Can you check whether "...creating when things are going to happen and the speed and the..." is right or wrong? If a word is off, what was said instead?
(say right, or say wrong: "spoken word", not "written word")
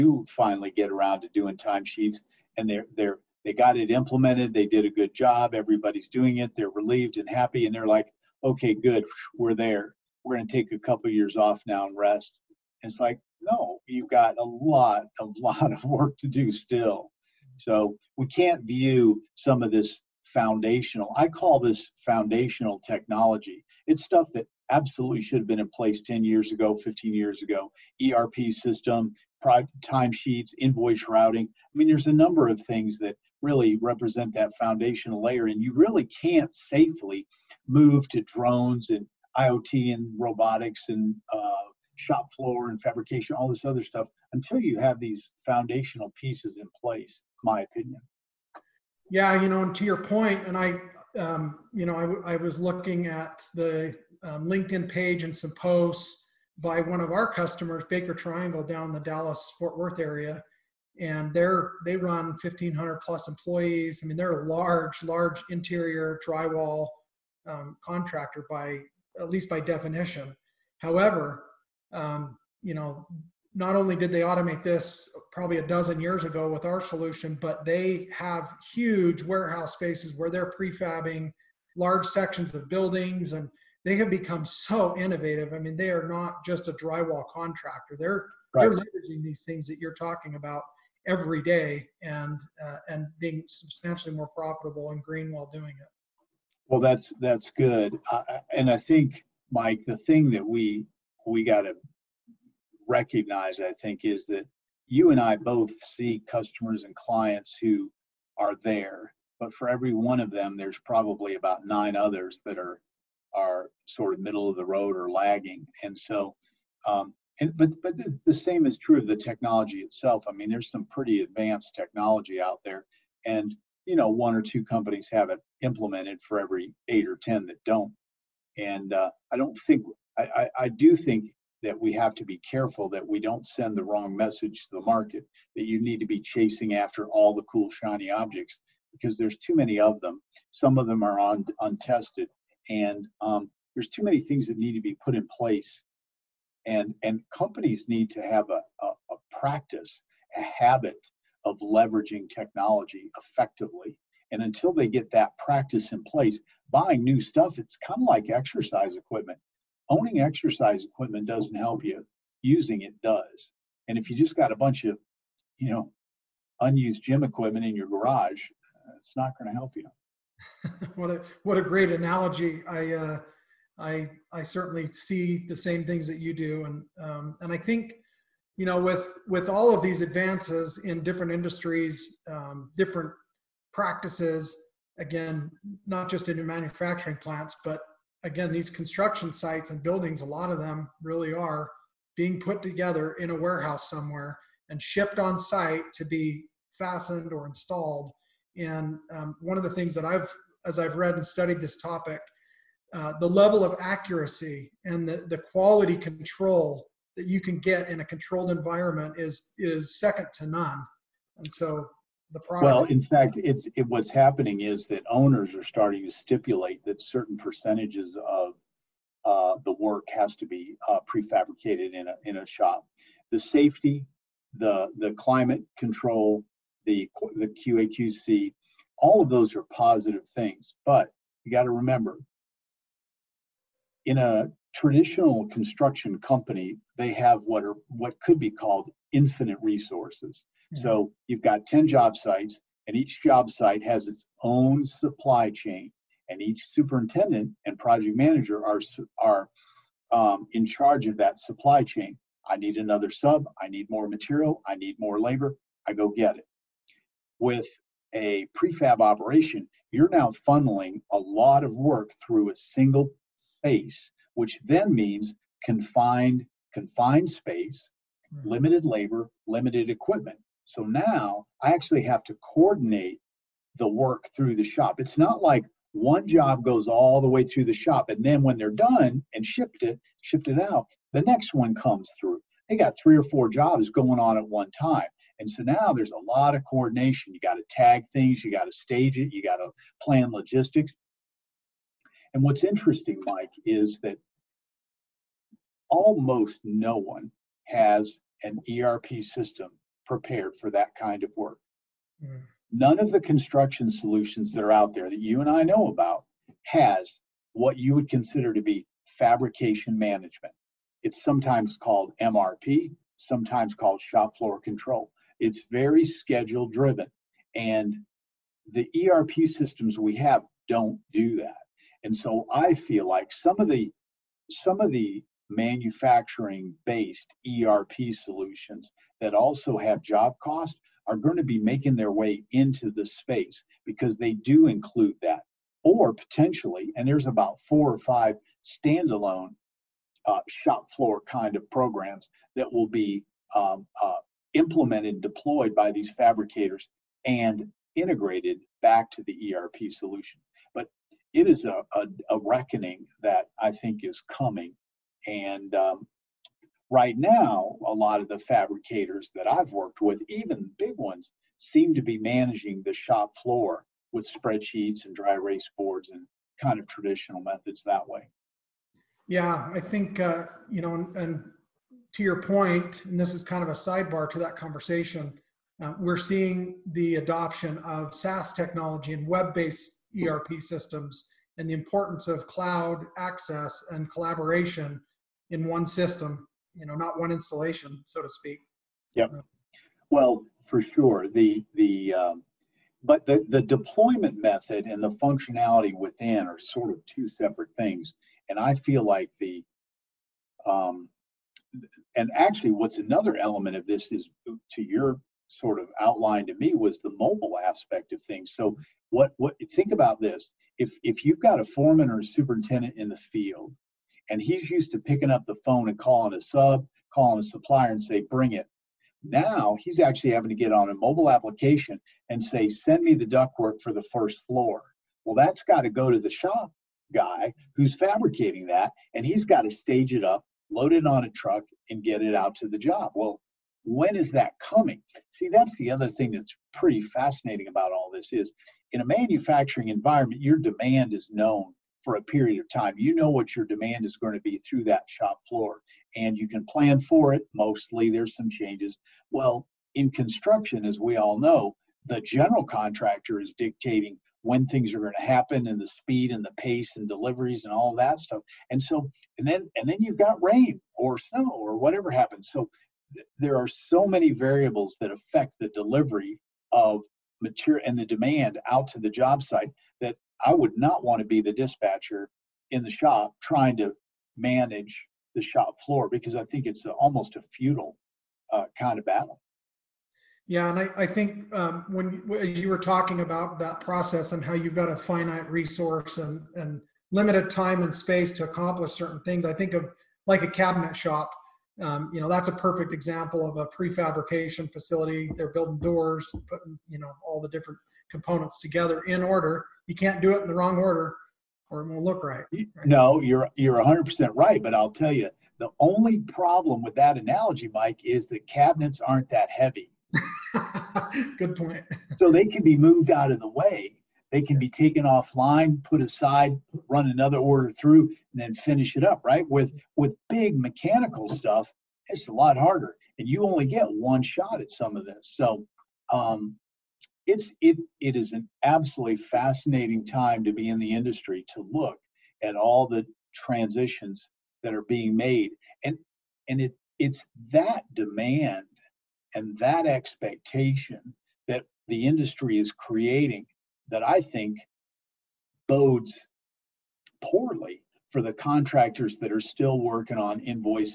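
wrong: "dictating", not "creating".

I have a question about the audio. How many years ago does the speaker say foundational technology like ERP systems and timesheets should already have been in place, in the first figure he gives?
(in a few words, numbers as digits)
10 years.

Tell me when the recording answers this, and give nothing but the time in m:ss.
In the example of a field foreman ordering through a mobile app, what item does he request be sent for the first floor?
7:03.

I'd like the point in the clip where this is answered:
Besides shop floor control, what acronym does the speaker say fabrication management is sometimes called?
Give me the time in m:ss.
5:12.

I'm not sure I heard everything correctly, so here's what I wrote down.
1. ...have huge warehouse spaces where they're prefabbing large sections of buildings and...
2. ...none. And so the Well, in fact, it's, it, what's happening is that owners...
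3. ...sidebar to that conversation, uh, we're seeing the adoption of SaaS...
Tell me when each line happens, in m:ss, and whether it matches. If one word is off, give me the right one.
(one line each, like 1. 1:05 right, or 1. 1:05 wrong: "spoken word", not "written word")
1. 1:18 right
2. 3:30 right
3. 6:13 right.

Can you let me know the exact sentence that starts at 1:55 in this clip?
And so, um, and, but but the, the same is true of the technology itself.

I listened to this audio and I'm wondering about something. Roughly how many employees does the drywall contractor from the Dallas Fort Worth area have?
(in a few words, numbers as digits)
1,500 plus.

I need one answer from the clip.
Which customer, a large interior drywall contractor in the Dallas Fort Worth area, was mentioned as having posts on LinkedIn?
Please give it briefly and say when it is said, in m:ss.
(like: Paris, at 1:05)
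Baker Triangle, at 0:57.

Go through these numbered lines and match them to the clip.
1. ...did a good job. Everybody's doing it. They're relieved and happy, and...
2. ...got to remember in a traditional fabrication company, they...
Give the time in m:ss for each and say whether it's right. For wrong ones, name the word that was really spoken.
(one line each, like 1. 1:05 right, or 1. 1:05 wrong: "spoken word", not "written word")
1. 0:04 right
2. 3:51 wrong: "construction", not "fabrication".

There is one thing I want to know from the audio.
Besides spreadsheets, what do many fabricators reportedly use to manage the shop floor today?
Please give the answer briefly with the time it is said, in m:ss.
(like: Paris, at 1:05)
Dry erase boards, at 6:05.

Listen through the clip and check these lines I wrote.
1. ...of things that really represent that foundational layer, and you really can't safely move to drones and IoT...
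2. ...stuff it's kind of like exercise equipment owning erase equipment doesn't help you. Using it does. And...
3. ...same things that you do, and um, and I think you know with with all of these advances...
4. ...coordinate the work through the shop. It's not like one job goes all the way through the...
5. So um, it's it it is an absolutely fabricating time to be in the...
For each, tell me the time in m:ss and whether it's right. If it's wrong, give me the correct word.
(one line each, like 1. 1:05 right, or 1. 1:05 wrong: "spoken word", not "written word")
1. 0:32 right
2. 2:37 wrong: "exercise", not "erase"
3. 2:55 right
4. 4:32 right
5. 8:45 wrong: "fascinating", not "fabricating".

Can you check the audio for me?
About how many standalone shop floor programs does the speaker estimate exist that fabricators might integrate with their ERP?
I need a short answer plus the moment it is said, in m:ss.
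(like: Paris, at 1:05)
Four or five, at 5:37.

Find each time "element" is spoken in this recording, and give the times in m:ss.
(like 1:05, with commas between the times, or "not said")
6:43.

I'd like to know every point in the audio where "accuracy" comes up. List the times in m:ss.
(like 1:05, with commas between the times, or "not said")
3:23.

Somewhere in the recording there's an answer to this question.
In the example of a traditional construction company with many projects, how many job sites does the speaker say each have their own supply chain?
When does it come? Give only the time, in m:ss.
4:01.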